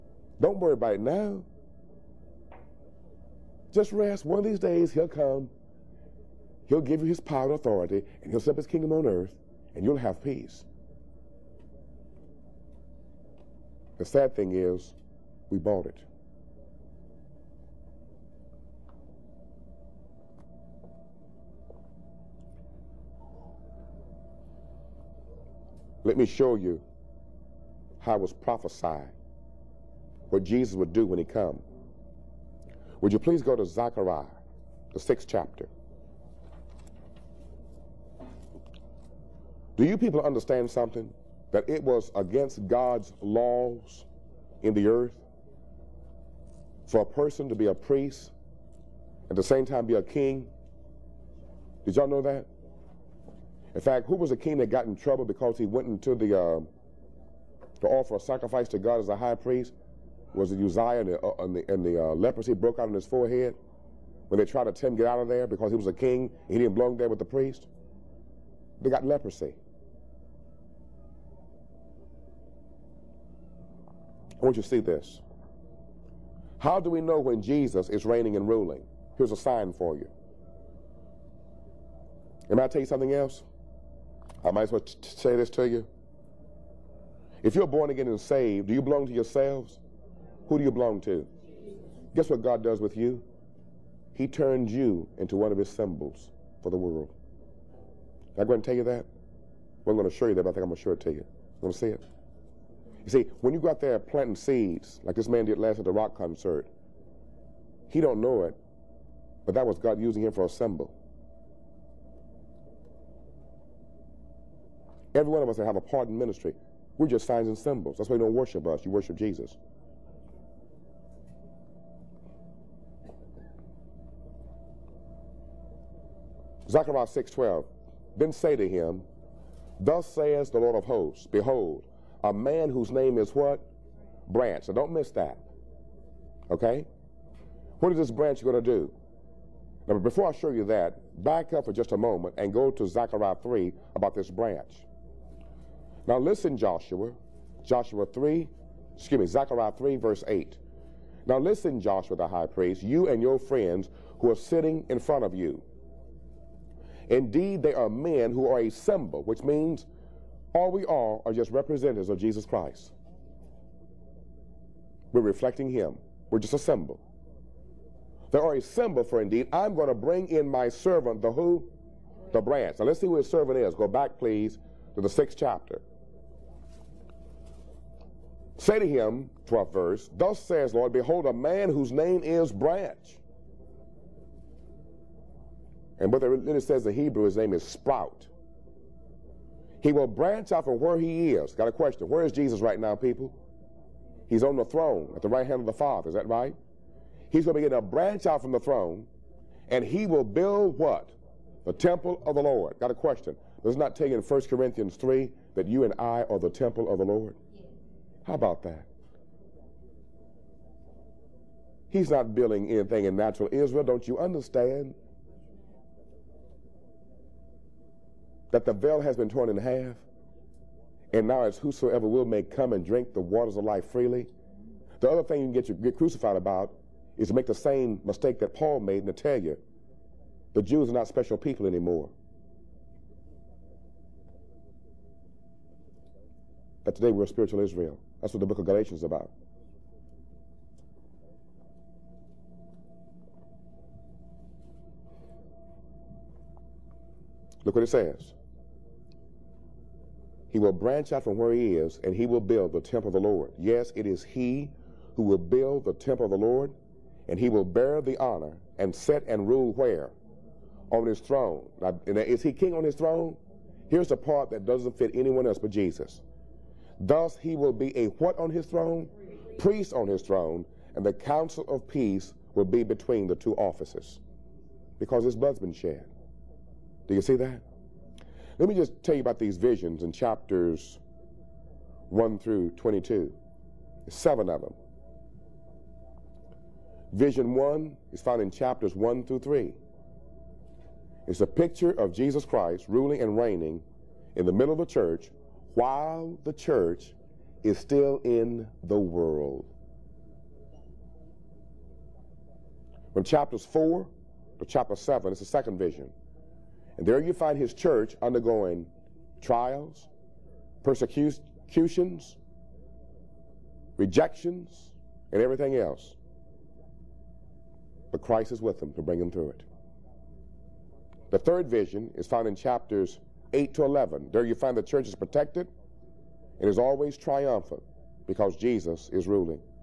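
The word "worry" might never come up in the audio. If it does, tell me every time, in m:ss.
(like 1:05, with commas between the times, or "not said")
0:00.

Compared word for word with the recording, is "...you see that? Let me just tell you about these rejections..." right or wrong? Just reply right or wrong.
wrong.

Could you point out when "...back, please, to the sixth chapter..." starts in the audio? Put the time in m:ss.
2:53.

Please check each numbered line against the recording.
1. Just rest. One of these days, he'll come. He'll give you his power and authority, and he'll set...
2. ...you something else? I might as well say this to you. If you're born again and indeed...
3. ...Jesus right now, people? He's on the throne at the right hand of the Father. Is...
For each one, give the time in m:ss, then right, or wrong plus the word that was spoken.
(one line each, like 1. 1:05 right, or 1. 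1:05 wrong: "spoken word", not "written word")
1. 0:03 right
2. 1:22 wrong: "saved", not "indeed"
3. 3:12 right.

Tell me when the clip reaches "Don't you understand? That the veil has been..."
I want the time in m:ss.
3:33.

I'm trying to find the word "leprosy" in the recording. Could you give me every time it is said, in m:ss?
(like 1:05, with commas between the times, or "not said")
1:02, 1:09.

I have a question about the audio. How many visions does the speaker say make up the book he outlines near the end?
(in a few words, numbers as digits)
7.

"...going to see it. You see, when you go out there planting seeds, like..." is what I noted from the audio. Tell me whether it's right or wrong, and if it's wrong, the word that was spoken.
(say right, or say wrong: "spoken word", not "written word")
right.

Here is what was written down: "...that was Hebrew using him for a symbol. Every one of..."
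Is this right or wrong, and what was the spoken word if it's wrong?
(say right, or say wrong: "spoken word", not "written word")
wrong: "God", not "Hebrew".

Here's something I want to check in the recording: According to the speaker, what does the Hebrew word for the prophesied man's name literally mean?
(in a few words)
Sprout.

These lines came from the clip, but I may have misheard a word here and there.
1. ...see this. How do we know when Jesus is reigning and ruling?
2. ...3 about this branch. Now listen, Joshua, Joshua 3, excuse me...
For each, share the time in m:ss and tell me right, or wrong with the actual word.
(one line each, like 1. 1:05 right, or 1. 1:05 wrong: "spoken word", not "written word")
1. 1:14 right
2. 2:23 right.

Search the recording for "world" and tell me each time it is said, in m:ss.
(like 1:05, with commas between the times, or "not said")
1:36, 4:58.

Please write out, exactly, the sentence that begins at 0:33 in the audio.
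Would you please go to Zechariah, the sixth chapter?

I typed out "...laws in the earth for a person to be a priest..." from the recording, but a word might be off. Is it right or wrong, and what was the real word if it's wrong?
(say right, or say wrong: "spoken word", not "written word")
right.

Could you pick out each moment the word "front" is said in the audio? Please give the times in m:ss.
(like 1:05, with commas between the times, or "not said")
2:34.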